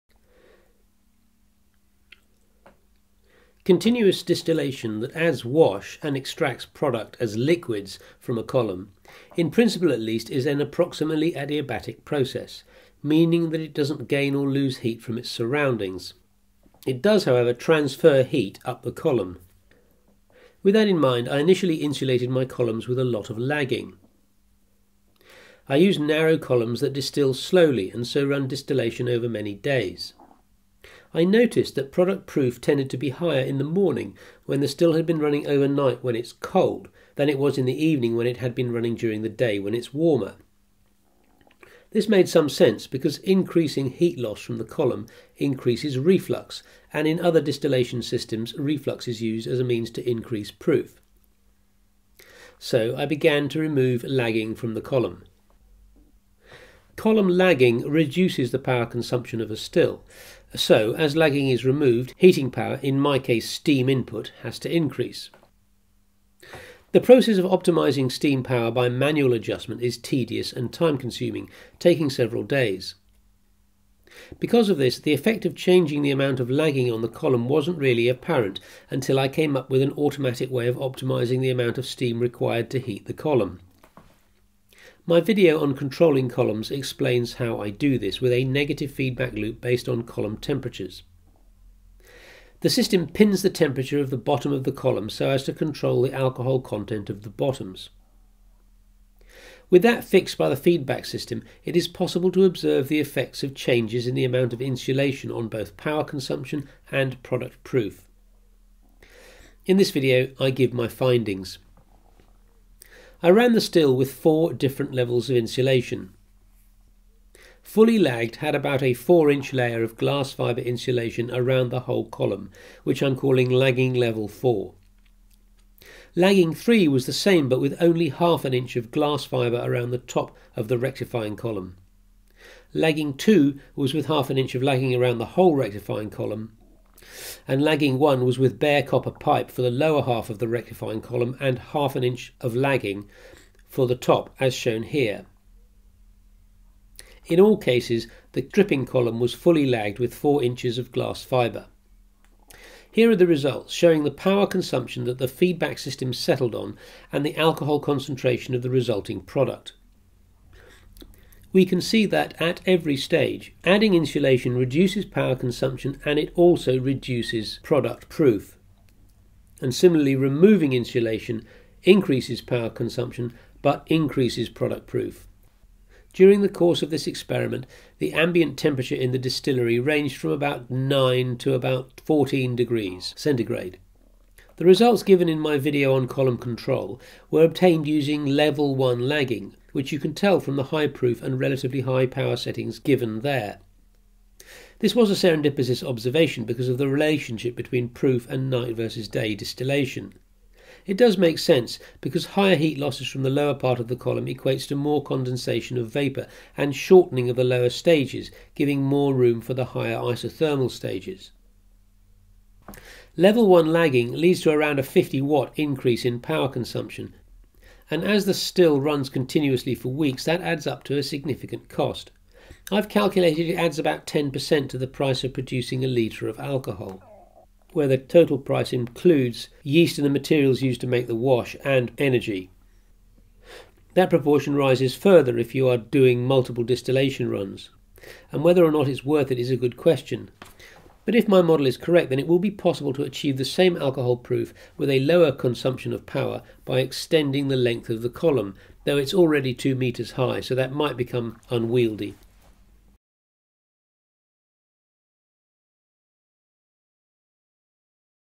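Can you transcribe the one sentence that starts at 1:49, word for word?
In this video, I give my findings.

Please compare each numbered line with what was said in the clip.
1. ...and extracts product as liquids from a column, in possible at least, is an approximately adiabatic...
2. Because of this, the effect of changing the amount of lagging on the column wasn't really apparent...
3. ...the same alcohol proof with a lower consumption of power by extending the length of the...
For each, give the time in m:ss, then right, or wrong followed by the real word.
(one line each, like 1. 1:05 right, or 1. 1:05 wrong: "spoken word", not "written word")
1. 0:06 wrong: "principle", not "possible"
2. 1:14 right
3. 4:03 right.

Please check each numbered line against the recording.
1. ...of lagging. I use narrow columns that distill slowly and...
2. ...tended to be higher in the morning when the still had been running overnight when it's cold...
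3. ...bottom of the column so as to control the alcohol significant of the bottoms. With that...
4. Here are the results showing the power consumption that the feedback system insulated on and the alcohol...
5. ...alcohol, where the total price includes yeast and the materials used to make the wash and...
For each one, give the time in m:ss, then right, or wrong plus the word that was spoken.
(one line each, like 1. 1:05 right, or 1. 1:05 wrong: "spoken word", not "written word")
1. 0:23 right
2. 0:32 right
3. 1:34 wrong: "content", not "significant"
4. 2:32 wrong: "settled", not "insulated"
5. 3:46 right.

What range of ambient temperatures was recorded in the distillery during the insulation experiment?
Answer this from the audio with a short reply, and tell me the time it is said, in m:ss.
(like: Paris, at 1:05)
9 to 14 degrees centigrade, at 3:00.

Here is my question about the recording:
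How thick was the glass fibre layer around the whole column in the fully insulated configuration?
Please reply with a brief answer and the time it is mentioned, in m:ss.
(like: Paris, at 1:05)
4 inch, at 1:58.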